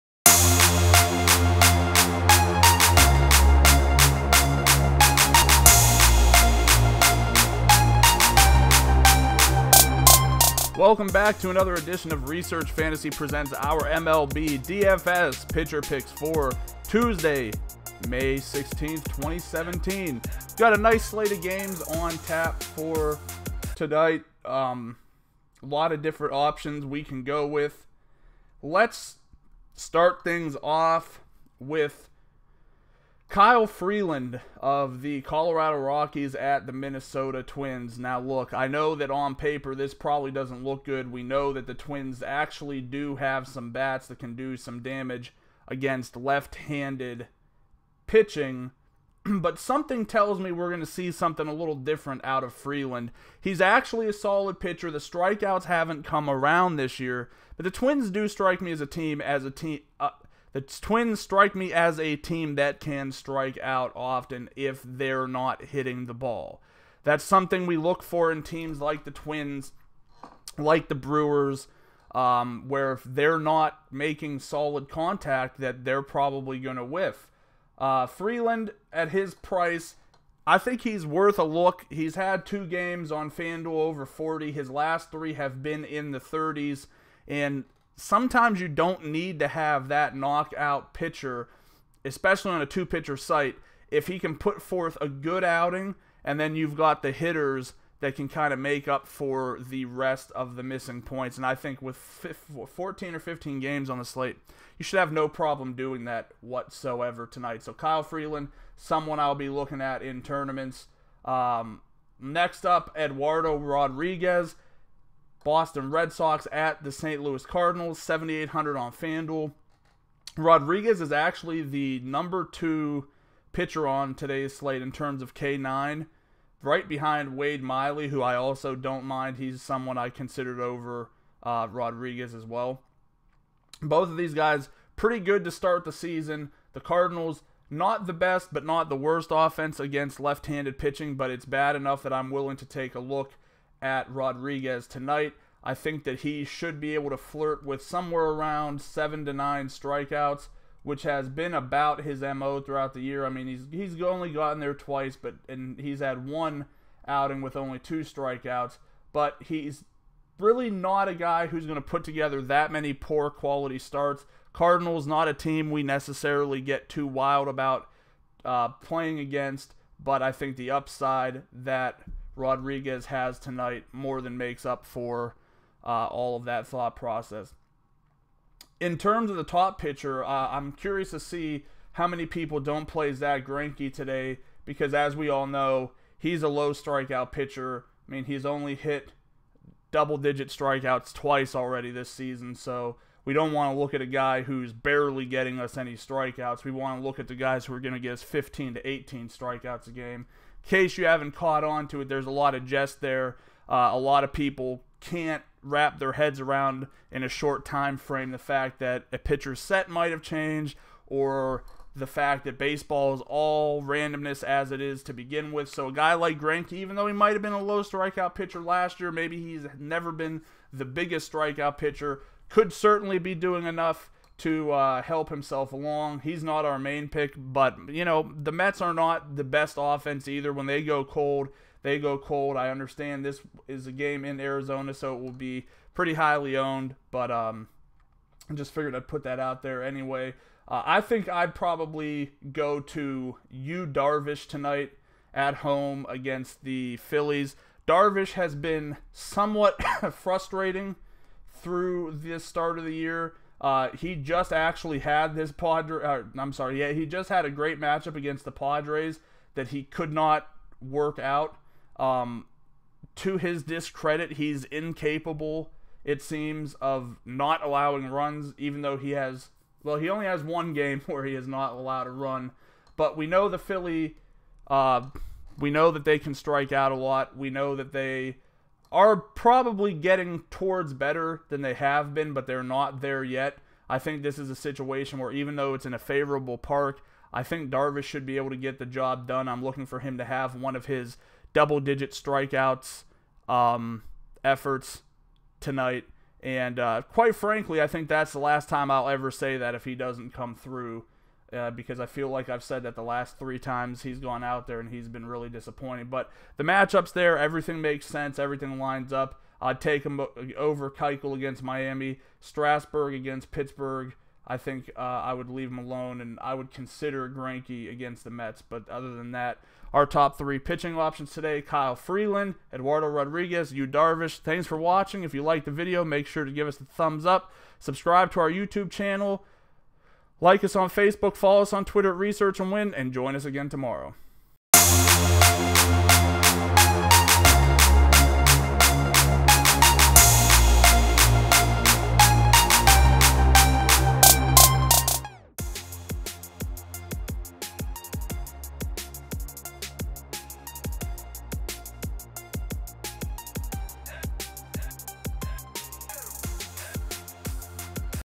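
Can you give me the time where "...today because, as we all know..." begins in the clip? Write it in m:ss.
3:03.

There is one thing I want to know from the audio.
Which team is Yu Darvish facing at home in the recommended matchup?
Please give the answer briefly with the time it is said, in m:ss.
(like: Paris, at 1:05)
Phillies, at 4:06.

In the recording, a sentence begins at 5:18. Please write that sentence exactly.
But other than that, our top three pitching options today: Kyle Freeland, Eduardo Rodriguez, Yu Darvish.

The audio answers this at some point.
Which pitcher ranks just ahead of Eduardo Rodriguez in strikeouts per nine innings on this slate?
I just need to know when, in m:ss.
2:07.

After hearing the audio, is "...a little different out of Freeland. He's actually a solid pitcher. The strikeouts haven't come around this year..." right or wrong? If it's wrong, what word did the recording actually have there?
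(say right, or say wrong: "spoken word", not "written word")
right.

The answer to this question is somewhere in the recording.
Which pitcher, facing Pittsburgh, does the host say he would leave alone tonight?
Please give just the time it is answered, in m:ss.
5:12.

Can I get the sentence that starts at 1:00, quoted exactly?
Uh, the Twins strike me as a team that can strike out often if they're not hitting the ball.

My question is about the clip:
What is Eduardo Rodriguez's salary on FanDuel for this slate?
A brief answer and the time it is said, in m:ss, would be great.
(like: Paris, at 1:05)
7,800, at 1:57.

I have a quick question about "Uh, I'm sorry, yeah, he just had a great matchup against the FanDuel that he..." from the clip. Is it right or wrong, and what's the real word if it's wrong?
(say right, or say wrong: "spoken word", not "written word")
wrong: "Padres", not "FanDuel".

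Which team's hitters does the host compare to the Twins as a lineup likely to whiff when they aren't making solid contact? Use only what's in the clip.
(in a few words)
Brewers.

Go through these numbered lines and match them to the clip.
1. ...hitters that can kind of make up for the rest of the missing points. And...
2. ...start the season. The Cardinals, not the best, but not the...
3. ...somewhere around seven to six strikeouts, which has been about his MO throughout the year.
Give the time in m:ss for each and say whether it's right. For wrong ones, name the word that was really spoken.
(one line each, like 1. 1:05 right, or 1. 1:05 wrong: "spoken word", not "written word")
1. 1:37 right
2. 2:15 right
3. 2:27 wrong: "nine", not "six".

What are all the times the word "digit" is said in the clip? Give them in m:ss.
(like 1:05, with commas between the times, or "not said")
3:09, 4:51.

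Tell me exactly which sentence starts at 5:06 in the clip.
But the matchups there, everything makes sense, everything lines up.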